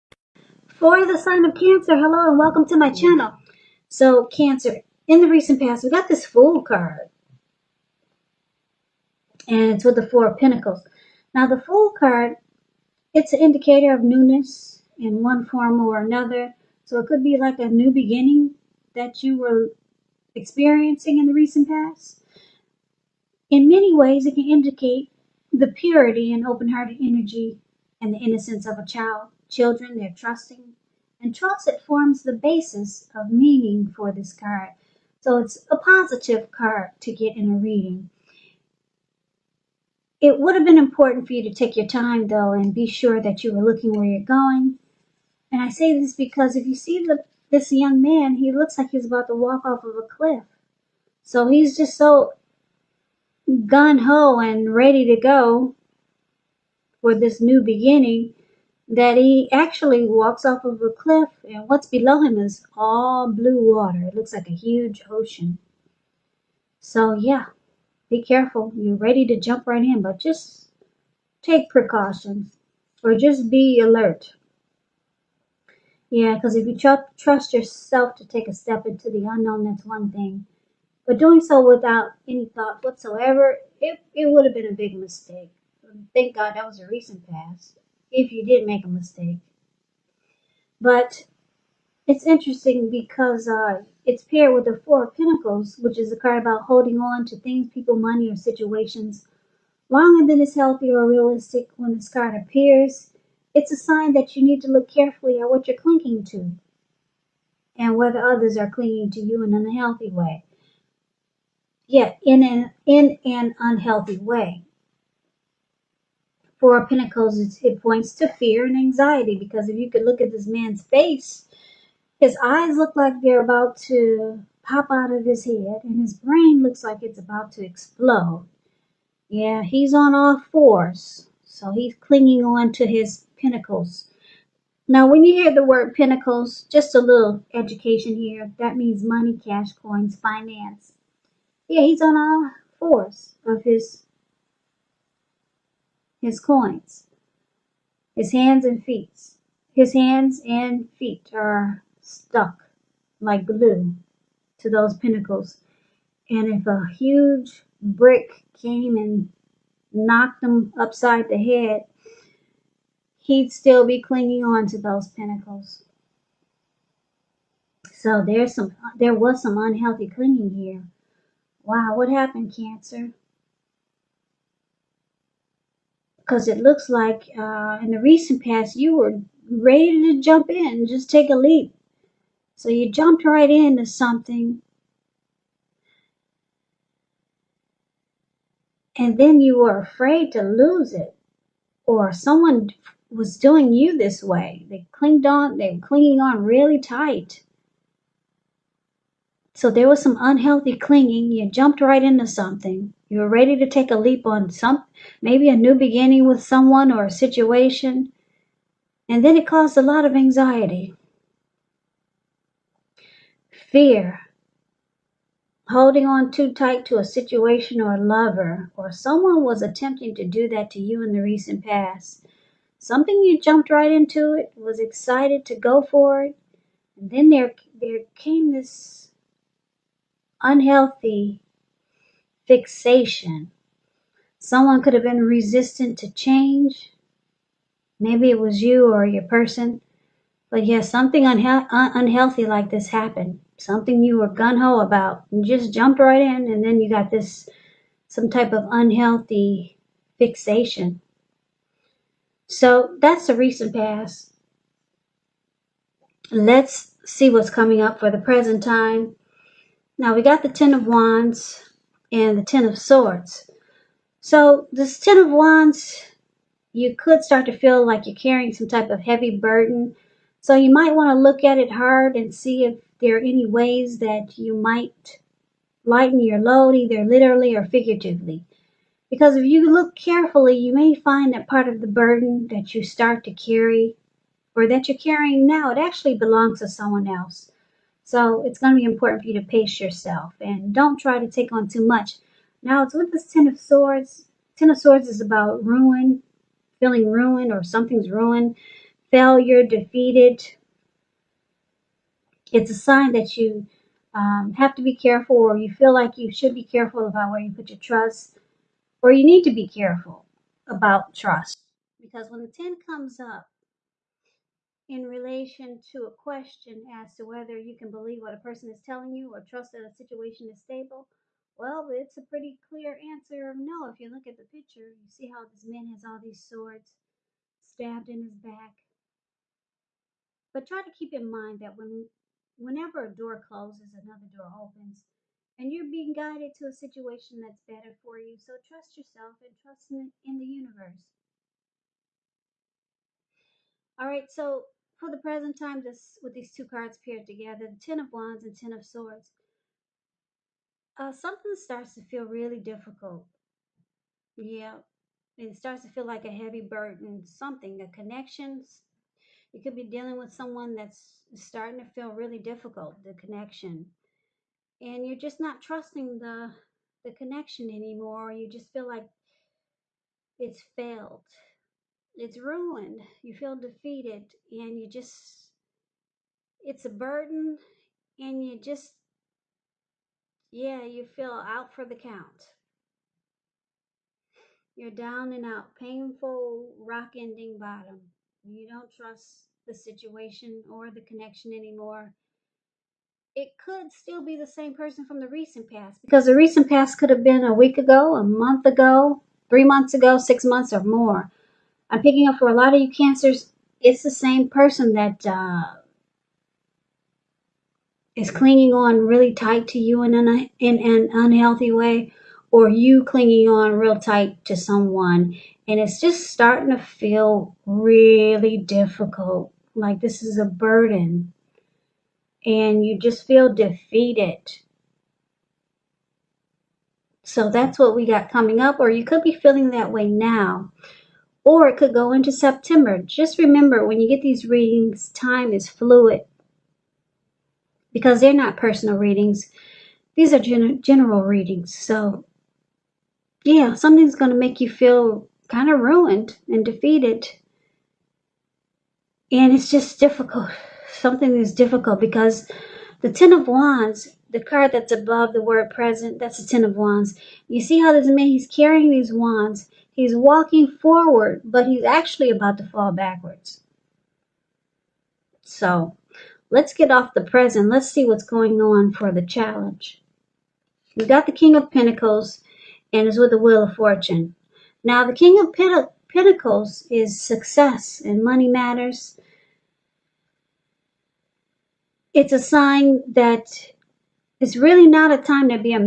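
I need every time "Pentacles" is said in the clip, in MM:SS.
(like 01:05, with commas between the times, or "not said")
00:10, 01:35, 01:56, 07:51, 07:56.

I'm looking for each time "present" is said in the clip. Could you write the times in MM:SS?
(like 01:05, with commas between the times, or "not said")
04:18, 05:45, 07:35, 07:47.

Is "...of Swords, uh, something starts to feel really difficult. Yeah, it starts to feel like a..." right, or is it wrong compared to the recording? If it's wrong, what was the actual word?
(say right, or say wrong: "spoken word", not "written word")
right.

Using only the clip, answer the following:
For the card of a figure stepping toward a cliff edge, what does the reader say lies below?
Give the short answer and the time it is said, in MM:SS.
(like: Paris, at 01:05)
blue water, at 01:03.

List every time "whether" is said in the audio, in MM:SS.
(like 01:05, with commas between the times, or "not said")
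01:47, 05:17.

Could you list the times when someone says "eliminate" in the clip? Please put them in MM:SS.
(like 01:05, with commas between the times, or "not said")
not said.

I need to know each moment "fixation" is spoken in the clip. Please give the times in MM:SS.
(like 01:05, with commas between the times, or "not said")
03:52, 04:10.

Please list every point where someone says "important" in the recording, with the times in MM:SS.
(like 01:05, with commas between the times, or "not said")
00:40, 04:48.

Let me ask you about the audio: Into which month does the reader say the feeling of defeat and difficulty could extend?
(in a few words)
September.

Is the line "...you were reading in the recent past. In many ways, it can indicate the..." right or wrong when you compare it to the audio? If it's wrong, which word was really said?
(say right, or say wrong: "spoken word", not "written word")
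wrong: "experiencing", not "reading".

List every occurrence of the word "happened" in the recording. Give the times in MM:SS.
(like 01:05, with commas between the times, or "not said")
02:52, 04:02.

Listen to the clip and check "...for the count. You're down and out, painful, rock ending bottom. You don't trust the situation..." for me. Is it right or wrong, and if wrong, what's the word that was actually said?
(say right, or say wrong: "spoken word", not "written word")
right.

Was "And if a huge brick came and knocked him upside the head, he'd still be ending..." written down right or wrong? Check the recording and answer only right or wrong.
wrong.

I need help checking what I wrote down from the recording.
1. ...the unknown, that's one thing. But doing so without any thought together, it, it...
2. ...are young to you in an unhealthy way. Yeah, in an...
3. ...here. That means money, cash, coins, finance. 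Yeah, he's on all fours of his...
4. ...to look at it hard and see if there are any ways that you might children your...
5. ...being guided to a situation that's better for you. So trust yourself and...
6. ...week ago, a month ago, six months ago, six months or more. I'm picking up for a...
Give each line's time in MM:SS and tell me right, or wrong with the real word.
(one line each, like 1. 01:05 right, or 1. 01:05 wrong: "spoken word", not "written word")
1. 01:19 wrong: "whatsoever", not "together"
2. 01:48 wrong: "clinging", not "young"
3. 02:18 right
4. 04:31 wrong: "lighten", not "children"
5. 05:35 right
6. 06:37 wrong: "three", not "six".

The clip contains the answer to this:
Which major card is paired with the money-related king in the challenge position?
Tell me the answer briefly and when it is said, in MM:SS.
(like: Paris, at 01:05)
Wheel of Fortune, at 07:53.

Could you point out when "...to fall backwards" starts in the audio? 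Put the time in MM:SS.
07:42.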